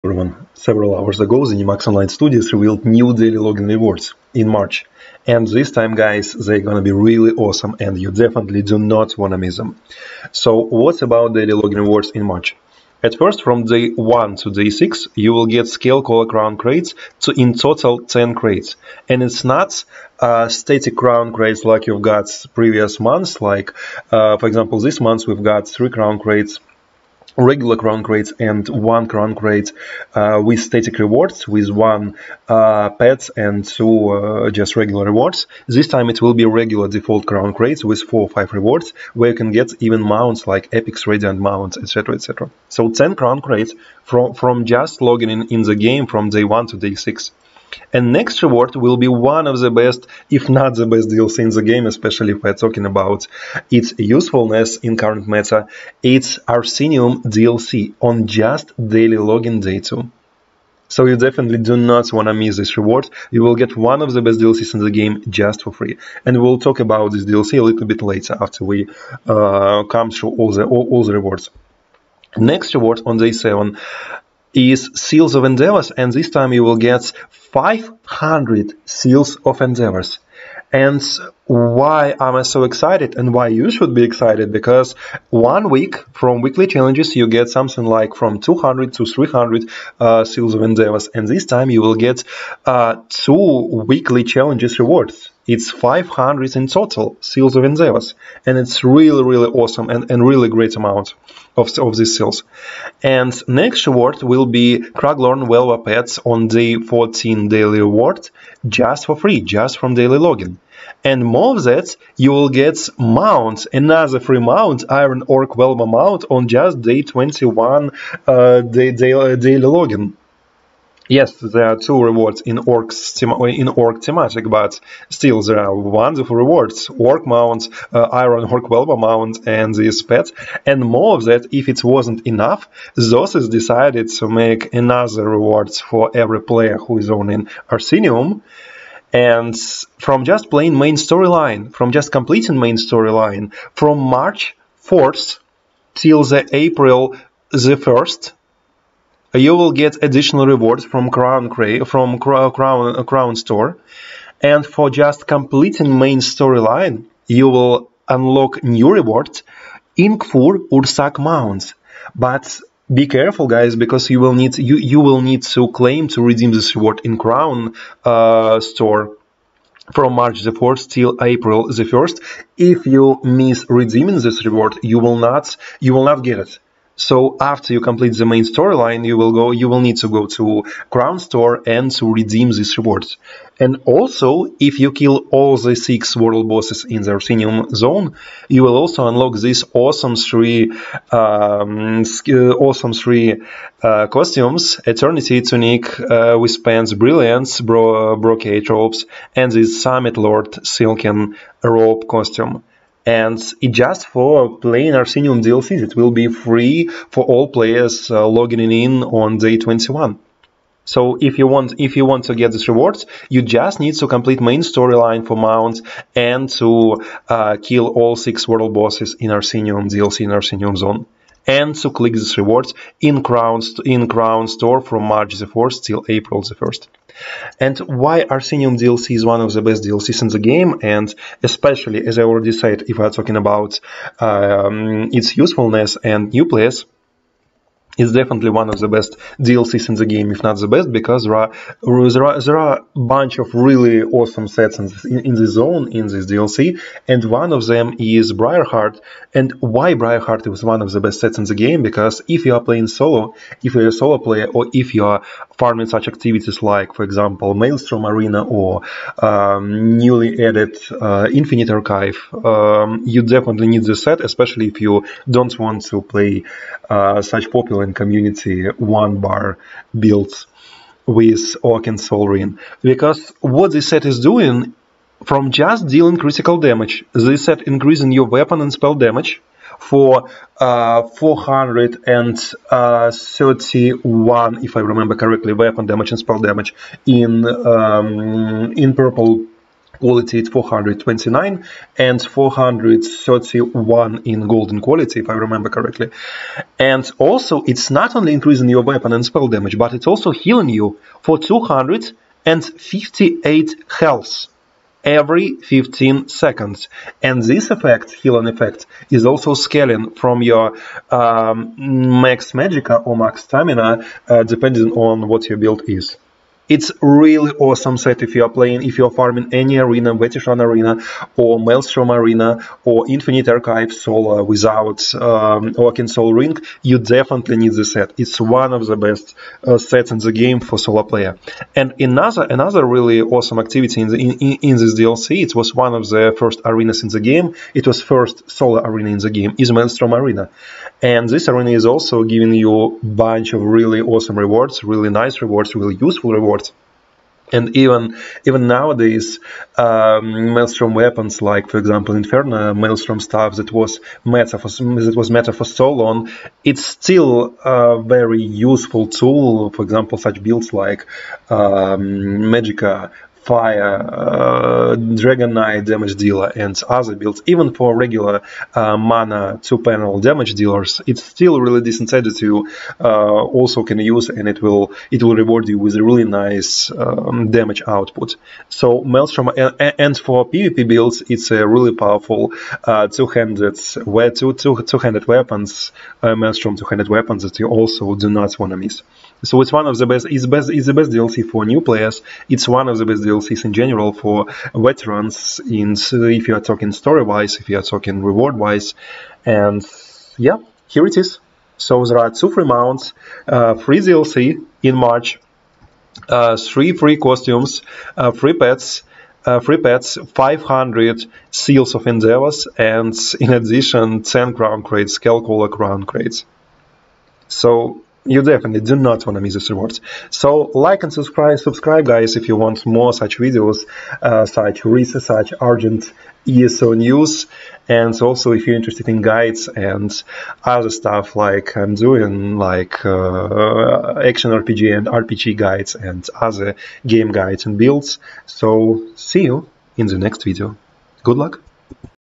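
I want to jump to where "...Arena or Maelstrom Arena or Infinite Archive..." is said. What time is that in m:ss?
5:20.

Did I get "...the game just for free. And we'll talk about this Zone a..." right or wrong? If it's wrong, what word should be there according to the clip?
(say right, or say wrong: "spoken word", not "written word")
wrong: "DLC", not "Zone".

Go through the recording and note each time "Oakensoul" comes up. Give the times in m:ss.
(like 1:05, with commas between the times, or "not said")
4:31, 5:25.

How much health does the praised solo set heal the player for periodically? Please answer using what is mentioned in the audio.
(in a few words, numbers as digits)
258.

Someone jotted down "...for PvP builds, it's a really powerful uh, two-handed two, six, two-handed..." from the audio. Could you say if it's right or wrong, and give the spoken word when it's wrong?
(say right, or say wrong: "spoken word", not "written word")
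wrong: "two", not "six".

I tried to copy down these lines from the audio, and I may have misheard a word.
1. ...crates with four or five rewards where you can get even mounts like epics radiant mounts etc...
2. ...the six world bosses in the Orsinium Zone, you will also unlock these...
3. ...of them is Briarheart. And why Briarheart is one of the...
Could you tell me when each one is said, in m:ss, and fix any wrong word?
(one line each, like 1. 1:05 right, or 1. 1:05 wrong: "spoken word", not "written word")
1. 0:37 right
2. 3:05 right
3. 4:07 right.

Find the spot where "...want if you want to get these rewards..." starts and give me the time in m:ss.
3:31.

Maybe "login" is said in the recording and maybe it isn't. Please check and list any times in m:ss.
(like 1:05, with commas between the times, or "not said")
0:03, 0:11, 0:59, 1:50, 1:59.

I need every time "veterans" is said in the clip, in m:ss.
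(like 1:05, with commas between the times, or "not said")
6:34.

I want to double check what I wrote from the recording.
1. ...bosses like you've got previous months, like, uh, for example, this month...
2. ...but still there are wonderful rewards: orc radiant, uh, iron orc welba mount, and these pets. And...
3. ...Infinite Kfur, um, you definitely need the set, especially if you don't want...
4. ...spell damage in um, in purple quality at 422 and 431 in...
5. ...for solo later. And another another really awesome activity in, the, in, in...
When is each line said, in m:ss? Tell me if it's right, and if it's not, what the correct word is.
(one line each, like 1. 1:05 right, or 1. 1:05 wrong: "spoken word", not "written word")
1. 0:21 wrong: "crates", not "bosses"
2. 2:04 wrong: "mount", not "radiant"
3. 4:21 wrong: "Archive", not "Kfur"
4. 4:46 wrong: "429", not "422"
5. 5:30 wrong: "player", not "later".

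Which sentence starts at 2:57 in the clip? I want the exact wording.
So after you complete the main storyline, you will go.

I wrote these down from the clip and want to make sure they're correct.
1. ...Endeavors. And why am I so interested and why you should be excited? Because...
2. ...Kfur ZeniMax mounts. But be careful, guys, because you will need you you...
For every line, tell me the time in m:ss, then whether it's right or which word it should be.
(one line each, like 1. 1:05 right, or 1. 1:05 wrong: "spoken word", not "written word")
1. 1:19 wrong: "excited", not "interested"
2. 2:40 wrong: "Ursak", not "ZeniMax".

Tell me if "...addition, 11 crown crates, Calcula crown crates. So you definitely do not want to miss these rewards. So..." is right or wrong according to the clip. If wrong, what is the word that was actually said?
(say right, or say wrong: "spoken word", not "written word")
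wrong: "10", not "11".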